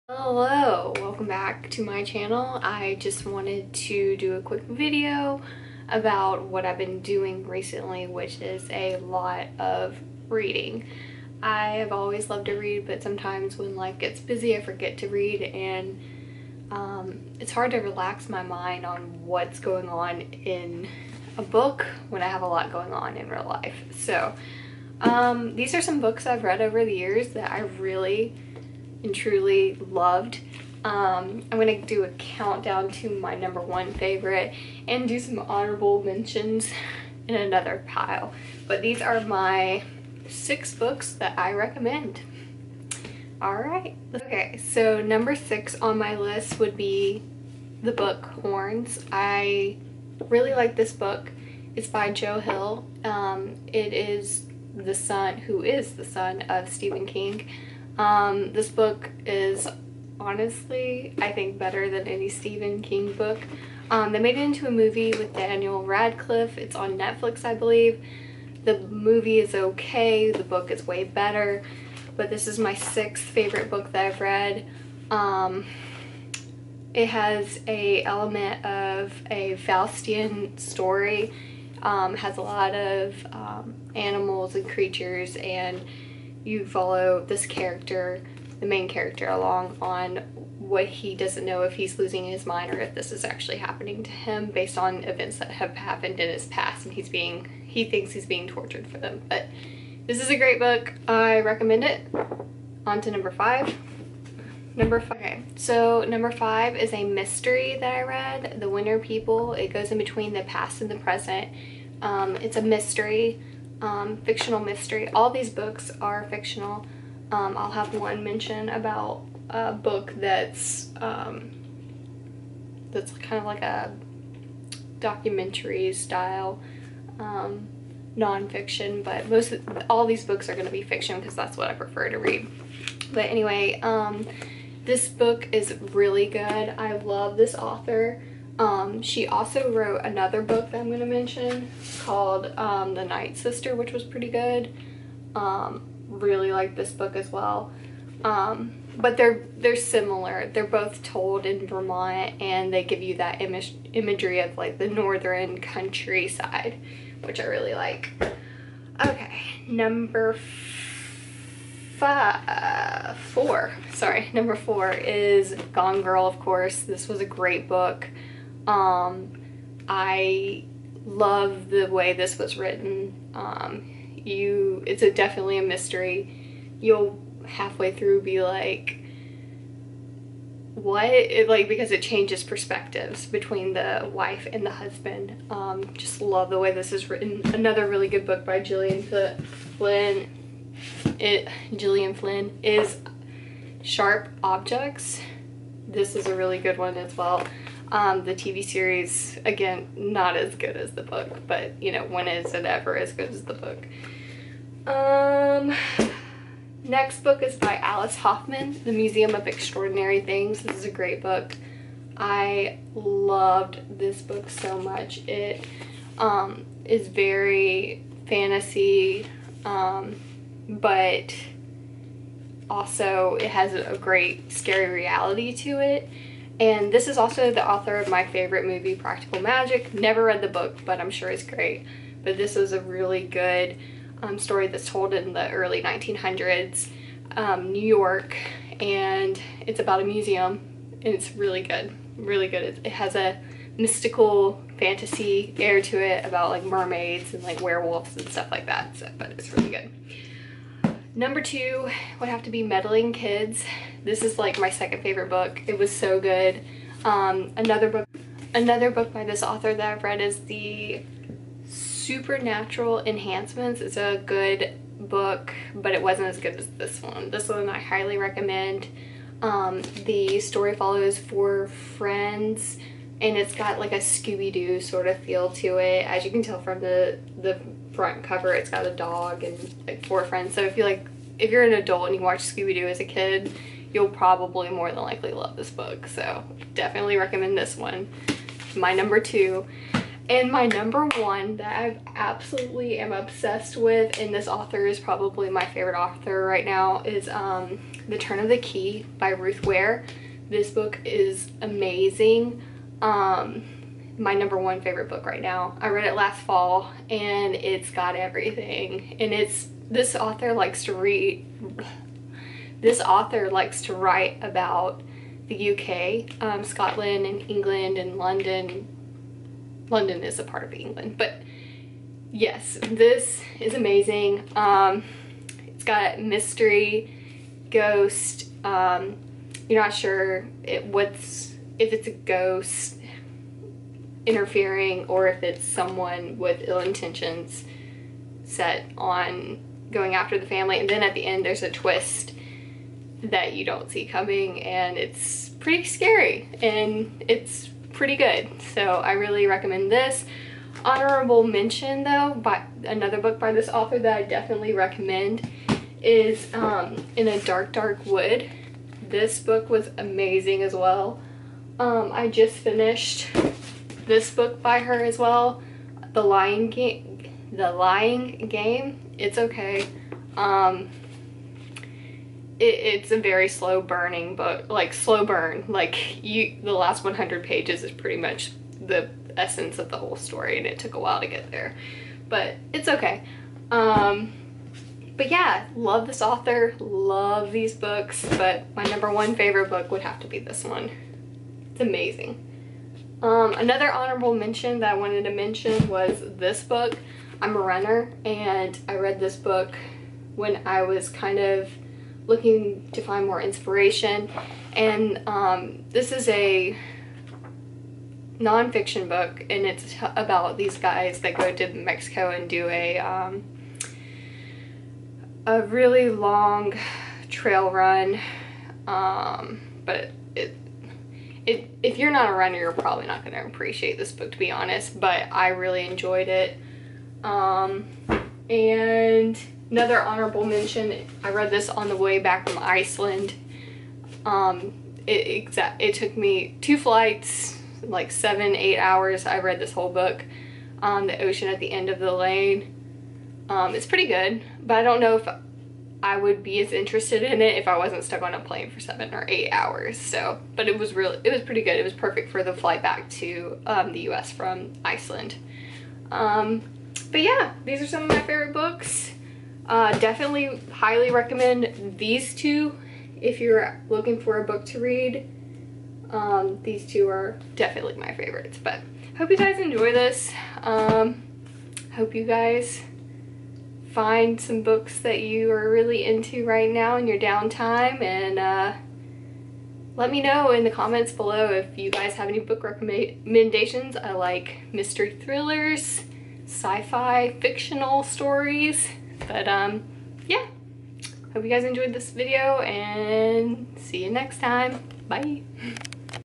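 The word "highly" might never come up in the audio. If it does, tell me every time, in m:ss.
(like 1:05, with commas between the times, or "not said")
4:27, 7:40.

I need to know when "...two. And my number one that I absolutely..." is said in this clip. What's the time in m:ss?
4:49.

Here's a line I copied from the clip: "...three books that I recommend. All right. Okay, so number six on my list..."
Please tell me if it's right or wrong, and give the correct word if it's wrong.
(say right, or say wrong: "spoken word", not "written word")
wrong: "six", not "three".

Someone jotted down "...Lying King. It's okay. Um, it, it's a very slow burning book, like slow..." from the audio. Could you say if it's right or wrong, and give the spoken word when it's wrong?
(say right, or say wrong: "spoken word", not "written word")
wrong: "Game", not "King".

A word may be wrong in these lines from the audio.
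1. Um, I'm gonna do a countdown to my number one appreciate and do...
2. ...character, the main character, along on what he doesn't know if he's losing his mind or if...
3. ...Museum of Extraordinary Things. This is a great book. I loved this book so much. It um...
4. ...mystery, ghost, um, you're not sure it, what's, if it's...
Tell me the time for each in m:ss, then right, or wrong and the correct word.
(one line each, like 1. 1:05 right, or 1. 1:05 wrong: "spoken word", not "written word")
1. 0:30 wrong: "favorite", not "appreciate"
2. 1:27 right
3. 3:28 right
4. 5:26 right.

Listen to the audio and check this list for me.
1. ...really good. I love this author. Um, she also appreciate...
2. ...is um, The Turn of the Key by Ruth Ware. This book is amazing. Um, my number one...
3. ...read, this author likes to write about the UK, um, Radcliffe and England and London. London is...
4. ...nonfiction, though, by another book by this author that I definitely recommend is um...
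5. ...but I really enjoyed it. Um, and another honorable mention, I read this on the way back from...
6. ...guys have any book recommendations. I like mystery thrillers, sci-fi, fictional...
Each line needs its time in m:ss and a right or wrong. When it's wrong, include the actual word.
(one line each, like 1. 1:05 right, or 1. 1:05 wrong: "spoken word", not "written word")
1. 2:15 wrong: "wrote", not "appreciate"
2. 4:57 right
3. 5:10 wrong: "Scotland", not "Radcliffe"
4. 5:51 wrong: "mention", not "nonfiction"
5. 7:04 right
6. 8:01 right.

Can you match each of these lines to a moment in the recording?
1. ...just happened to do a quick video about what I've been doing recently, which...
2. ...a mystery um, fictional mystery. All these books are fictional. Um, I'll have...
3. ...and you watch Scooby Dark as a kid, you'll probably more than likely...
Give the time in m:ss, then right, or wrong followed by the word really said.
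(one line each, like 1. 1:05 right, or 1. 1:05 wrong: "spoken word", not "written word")
1. 0:02 wrong: "wanted", not "happened"
2. 1:52 right
3. 4:42 wrong: "Doo", not "Dark".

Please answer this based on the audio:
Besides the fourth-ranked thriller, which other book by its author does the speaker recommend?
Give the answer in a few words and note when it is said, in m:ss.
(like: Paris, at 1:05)
Sharp Objects, at 3:13.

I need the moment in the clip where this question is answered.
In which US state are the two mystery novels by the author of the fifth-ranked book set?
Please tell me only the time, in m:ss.
2:31.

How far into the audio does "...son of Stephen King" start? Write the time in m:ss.
0:56.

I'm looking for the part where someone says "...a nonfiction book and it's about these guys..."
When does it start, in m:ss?
6:46.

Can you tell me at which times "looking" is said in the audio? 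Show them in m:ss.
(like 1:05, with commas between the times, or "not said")
6:42, 7:43.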